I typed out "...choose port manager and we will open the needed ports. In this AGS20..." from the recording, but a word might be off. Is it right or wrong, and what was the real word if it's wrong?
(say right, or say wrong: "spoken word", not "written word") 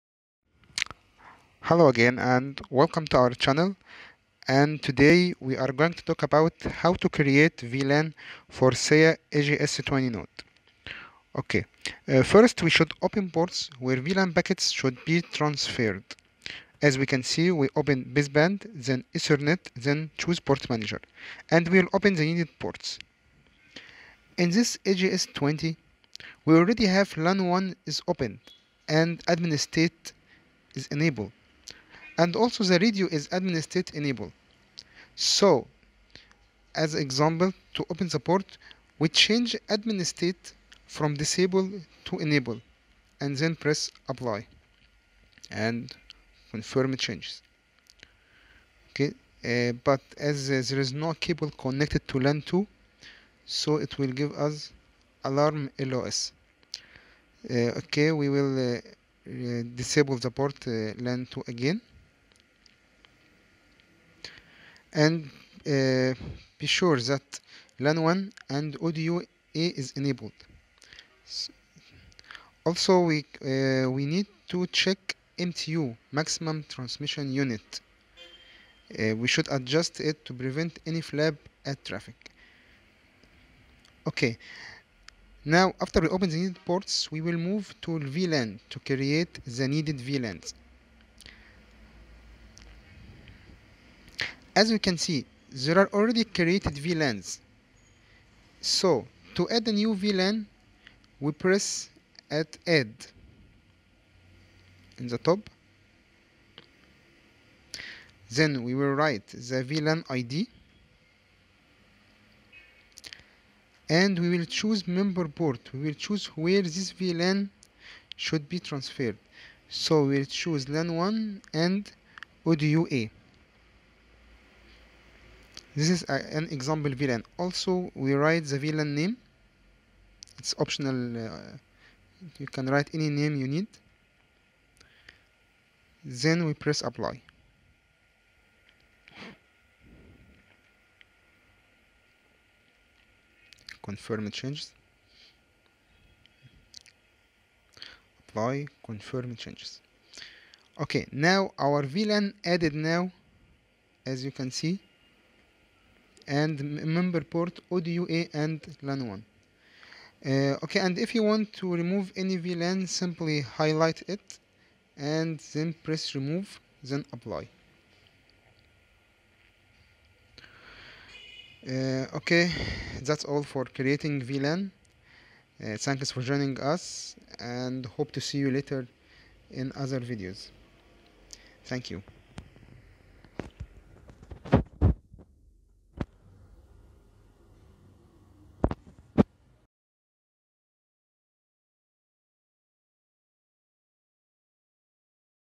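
right.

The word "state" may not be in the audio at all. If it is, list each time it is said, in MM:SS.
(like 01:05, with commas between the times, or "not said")
00:29, 00:33, 00:40.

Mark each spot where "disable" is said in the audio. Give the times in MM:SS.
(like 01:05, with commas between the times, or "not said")
00:41, 00:59.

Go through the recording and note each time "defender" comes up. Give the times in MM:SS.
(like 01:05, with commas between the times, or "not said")
not said.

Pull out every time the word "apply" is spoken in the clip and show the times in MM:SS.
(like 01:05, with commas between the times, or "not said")
00:44, 02:16, 02:28, 02:47.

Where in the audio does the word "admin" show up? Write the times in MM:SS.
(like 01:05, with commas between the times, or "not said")
00:29, 00:33, 00:39.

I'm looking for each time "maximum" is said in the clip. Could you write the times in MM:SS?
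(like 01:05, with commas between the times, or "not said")
01:16.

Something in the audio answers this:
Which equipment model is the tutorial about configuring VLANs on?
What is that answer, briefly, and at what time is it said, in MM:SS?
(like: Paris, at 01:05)
SIAE AGS20, at 00:08.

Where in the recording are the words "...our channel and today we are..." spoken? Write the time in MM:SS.
00:03.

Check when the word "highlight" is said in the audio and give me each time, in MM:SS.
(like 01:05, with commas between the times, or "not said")
02:43.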